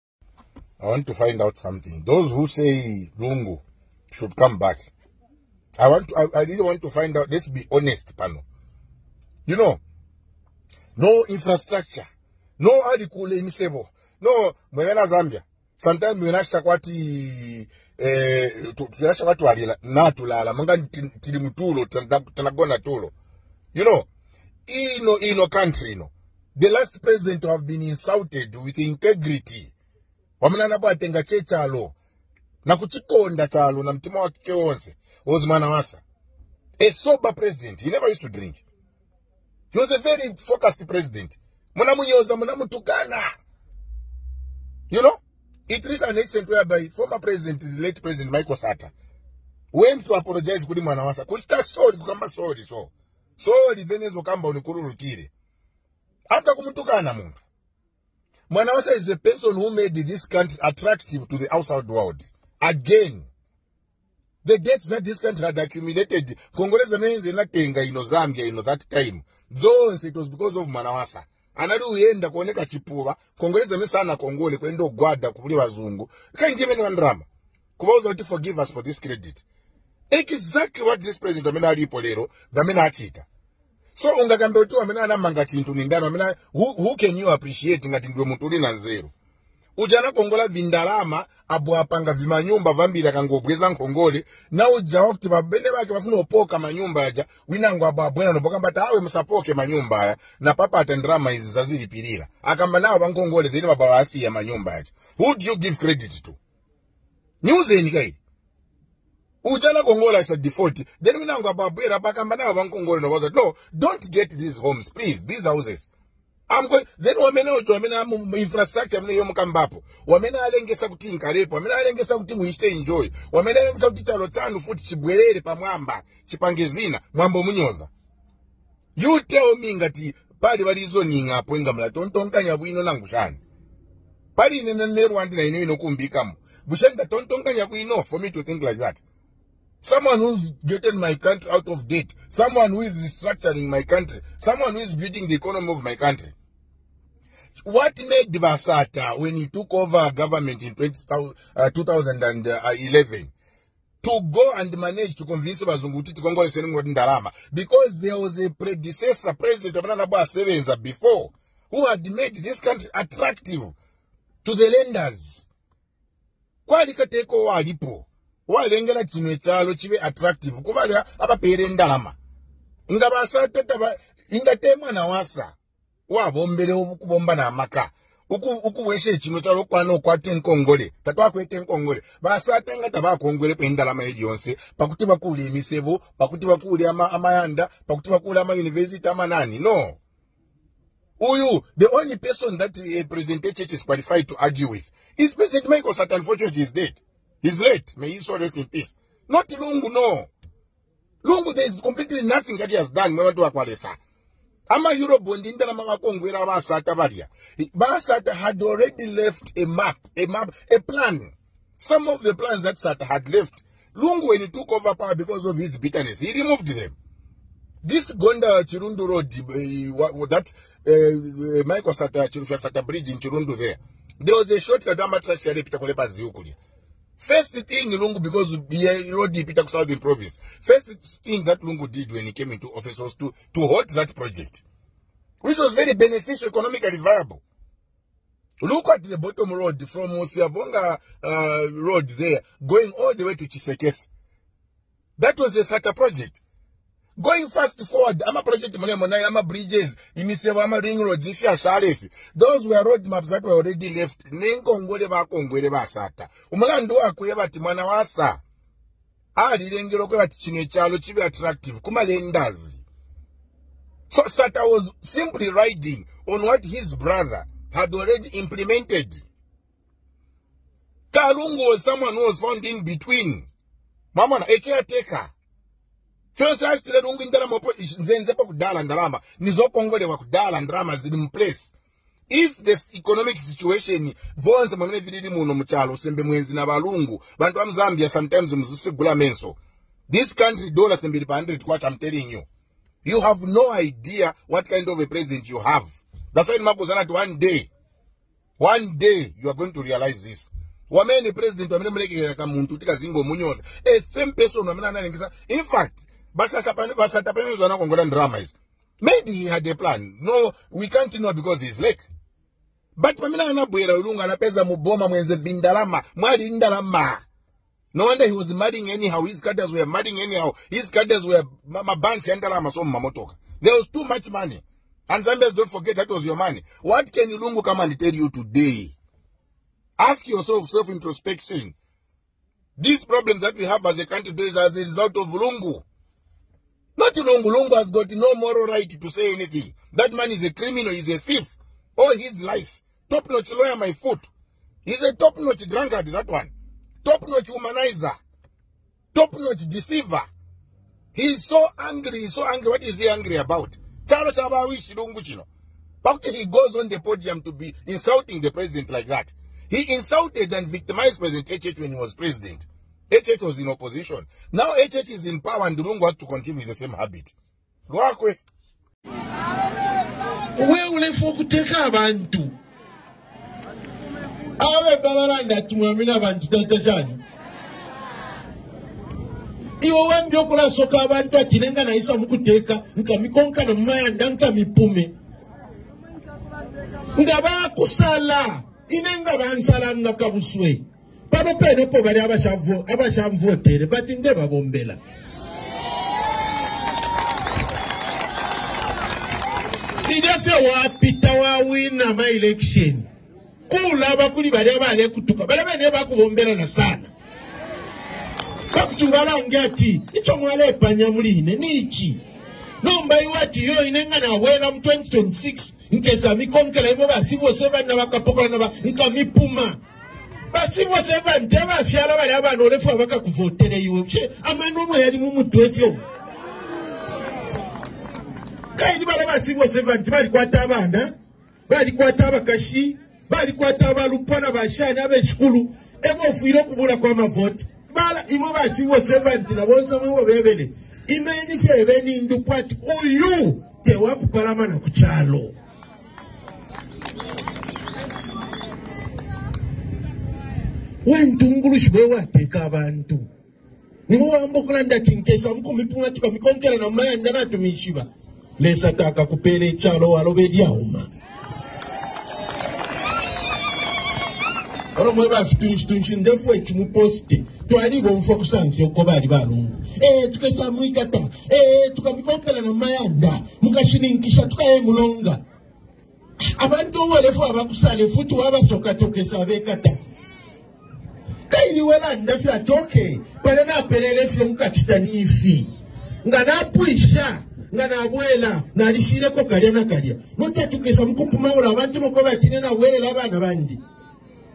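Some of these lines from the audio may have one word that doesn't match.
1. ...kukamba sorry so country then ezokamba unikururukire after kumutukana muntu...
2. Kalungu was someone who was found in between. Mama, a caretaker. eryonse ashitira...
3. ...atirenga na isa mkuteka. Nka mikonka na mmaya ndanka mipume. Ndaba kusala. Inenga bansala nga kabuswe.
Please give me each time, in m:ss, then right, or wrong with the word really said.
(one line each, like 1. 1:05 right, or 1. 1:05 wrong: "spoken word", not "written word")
1. 0:51 wrong: "sorry", not "country"
2. 4:31 wrong: "fyonse", not "eryonse"
3. 6:21 right.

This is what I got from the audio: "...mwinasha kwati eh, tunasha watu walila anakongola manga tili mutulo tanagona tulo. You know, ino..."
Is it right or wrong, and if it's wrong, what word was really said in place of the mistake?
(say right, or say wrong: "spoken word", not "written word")
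wrong: "natulala", not "anakongola".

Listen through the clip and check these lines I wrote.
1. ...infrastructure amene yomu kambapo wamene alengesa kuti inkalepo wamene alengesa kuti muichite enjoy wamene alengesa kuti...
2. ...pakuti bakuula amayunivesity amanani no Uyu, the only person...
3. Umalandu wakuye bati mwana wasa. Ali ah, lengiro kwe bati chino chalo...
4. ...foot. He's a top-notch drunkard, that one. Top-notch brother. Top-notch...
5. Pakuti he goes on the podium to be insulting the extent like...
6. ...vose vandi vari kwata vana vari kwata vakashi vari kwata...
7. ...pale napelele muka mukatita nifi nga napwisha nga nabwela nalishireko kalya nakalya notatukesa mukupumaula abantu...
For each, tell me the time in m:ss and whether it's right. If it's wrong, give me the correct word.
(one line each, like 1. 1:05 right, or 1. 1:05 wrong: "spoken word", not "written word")
1. 1:58 right
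2. 3:07 right
3. 4:16 right
4. 5:43 wrong: "humanizer", not "brother"
5. 5:56 wrong: "president", not "extent"
6. 7:09 right
7. 8:03 right.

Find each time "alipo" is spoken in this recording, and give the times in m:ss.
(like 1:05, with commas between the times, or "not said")
1:21, 2:47.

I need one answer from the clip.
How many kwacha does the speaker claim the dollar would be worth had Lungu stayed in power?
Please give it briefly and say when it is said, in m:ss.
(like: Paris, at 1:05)
100 kwacha, at 4:51.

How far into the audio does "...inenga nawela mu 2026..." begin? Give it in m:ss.
6:53.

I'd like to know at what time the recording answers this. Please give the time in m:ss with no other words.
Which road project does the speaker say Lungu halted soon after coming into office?
3:38.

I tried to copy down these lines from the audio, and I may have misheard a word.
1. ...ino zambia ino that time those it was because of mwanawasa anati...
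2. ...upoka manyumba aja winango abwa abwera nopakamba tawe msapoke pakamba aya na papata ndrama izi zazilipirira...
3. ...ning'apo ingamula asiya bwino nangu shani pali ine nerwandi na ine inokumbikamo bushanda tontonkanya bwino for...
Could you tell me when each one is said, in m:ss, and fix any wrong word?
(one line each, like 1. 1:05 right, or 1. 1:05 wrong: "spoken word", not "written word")
1. 1:07 right
2. 1:36 wrong: "manyumba", not "pakamba"
3. 2:11 wrong: "tontonkanya", not "asiya".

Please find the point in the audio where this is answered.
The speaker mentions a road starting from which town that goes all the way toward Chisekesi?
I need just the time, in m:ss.
4:00.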